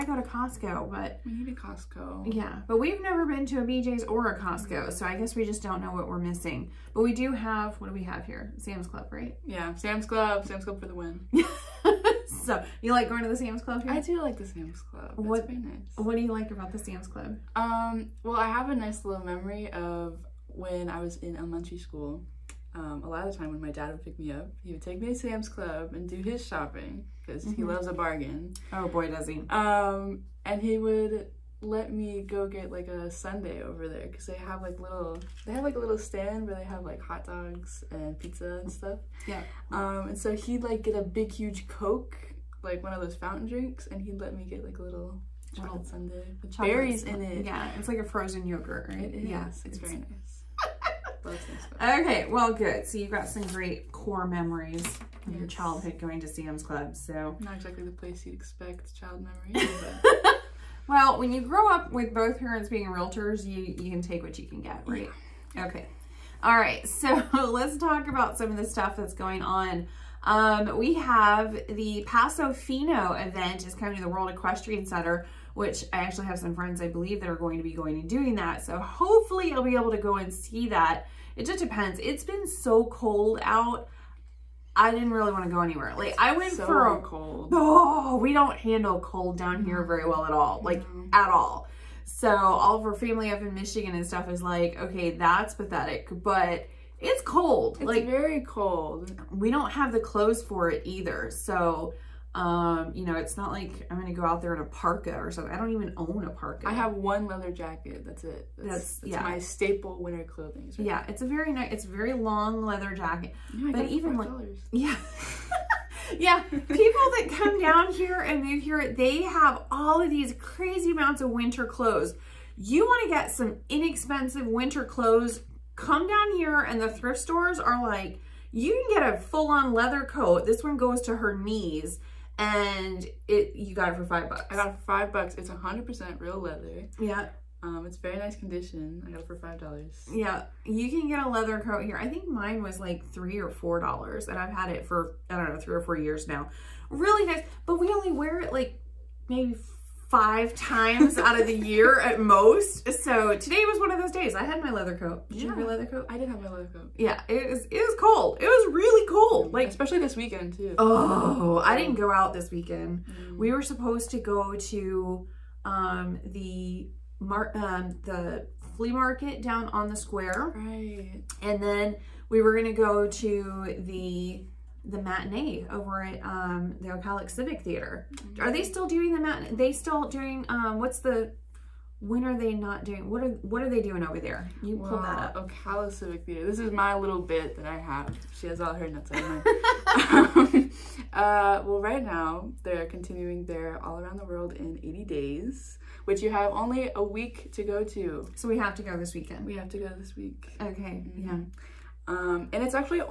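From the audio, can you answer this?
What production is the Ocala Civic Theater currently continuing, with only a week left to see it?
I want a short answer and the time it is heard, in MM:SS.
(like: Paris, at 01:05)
All Around the World in 80 Days, at 03:13.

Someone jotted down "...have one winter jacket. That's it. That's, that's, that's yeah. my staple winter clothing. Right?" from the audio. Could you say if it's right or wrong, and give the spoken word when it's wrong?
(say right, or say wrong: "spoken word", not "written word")
wrong: "leather", not "winter".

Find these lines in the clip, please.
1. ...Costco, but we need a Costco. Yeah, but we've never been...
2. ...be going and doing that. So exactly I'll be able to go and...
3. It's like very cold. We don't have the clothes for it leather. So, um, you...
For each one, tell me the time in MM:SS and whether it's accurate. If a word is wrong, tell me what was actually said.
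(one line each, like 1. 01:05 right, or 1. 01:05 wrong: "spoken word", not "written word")
1. 00:00 right
2. 01:17 wrong: "hopefully", not "exactly"
3. 01:37 wrong: "either", not "leather".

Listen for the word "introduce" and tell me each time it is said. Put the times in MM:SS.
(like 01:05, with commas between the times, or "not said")
not said.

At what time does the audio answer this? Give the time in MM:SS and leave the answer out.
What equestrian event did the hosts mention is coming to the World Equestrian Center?
01:12.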